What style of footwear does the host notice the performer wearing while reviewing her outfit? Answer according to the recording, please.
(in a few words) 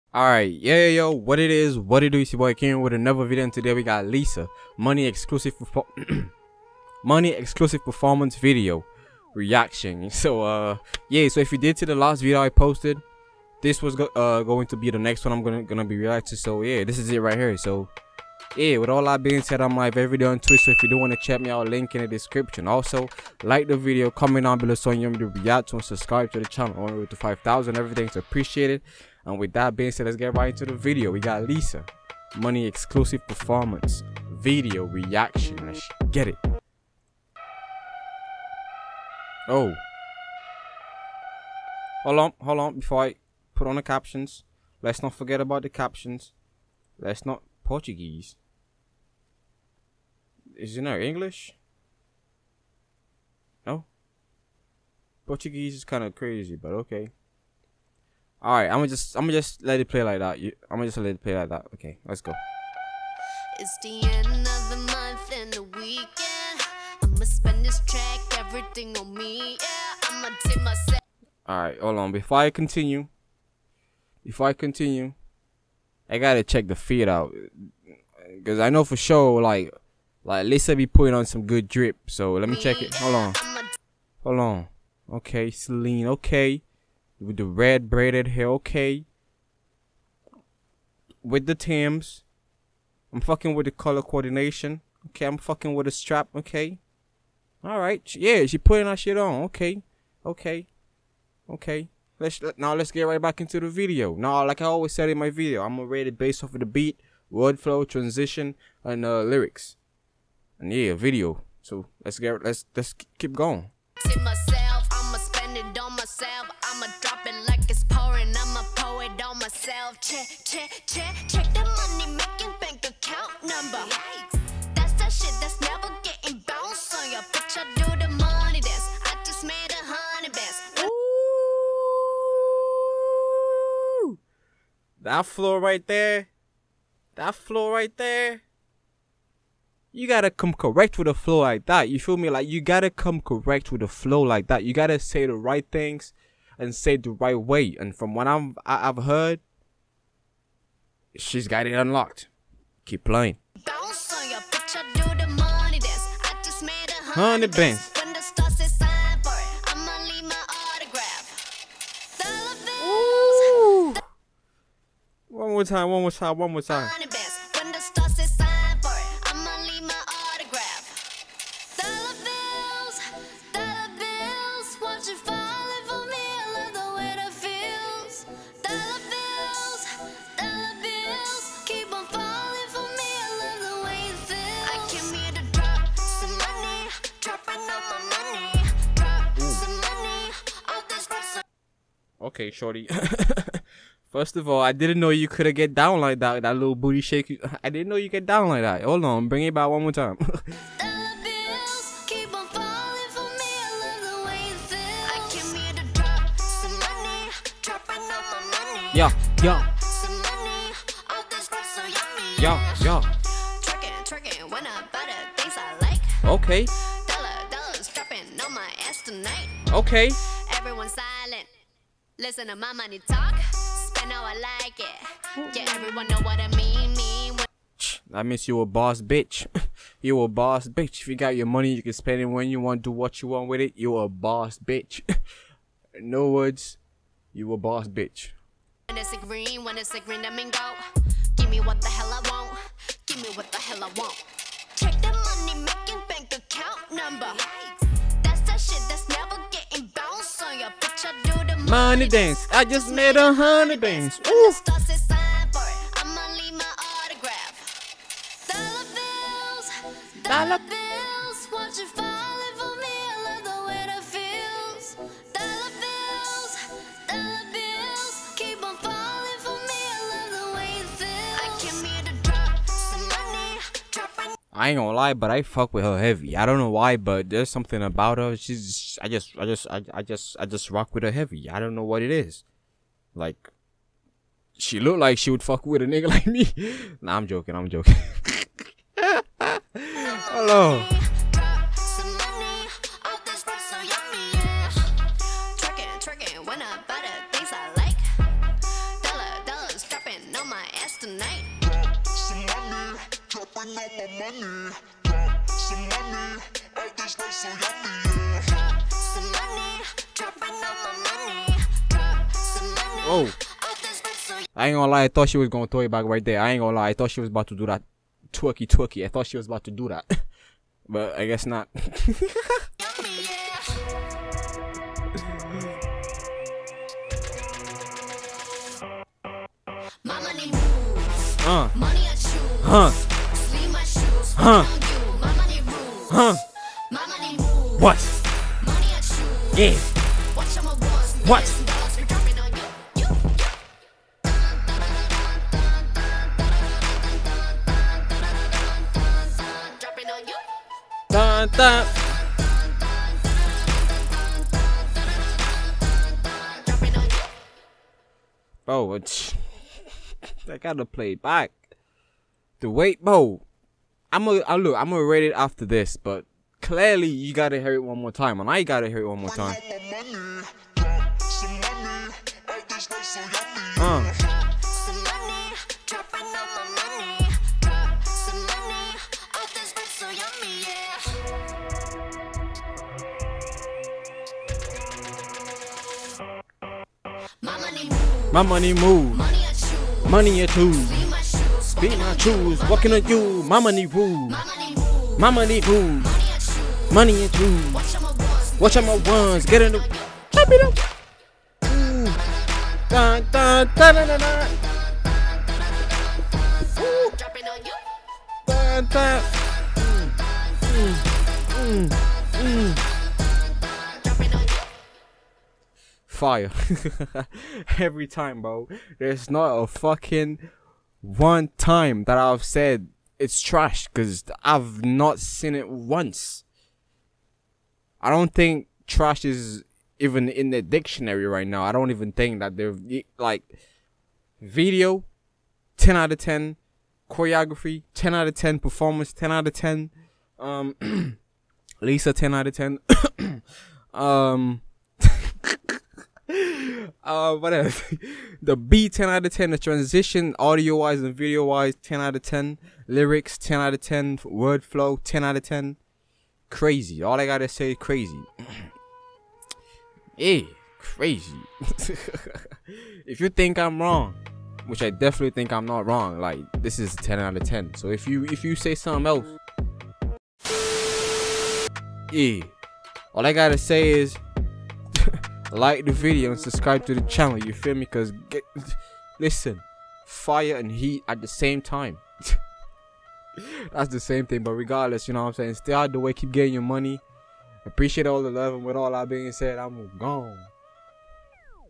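Tims.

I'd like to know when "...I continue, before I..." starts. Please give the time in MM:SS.
01:12.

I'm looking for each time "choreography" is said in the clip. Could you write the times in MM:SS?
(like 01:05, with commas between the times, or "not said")
07:17.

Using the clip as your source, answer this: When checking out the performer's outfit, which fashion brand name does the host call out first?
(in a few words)
Celine.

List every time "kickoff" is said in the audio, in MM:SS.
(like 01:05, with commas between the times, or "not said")
not said.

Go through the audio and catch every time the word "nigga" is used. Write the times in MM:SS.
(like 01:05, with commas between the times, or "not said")
04:45.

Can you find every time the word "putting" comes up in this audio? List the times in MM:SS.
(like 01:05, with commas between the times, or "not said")
01:20, 01:38.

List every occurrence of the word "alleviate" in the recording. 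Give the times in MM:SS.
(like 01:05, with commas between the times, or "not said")
not said.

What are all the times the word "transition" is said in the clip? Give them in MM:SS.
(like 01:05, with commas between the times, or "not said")
01:47, 07:29.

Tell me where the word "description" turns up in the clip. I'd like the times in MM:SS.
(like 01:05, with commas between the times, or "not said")
00:22.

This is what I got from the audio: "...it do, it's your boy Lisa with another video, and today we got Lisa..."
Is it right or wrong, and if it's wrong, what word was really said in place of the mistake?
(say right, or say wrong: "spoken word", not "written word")
wrong: "Came", not "Lisa".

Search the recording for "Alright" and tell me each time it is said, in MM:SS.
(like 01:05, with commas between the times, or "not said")
00:00, 01:37.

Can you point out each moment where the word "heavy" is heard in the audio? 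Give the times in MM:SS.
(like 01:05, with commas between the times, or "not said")
04:35, 04:41.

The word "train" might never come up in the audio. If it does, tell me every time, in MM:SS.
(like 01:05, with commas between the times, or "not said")
not said.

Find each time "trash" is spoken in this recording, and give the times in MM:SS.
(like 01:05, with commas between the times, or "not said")
07:03, 07:08.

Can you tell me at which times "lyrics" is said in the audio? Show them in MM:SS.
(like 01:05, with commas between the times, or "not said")
01:49, 07:32.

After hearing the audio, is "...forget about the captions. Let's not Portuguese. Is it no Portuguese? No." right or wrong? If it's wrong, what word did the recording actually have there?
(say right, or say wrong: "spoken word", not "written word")
wrong: "English", not "Portuguese".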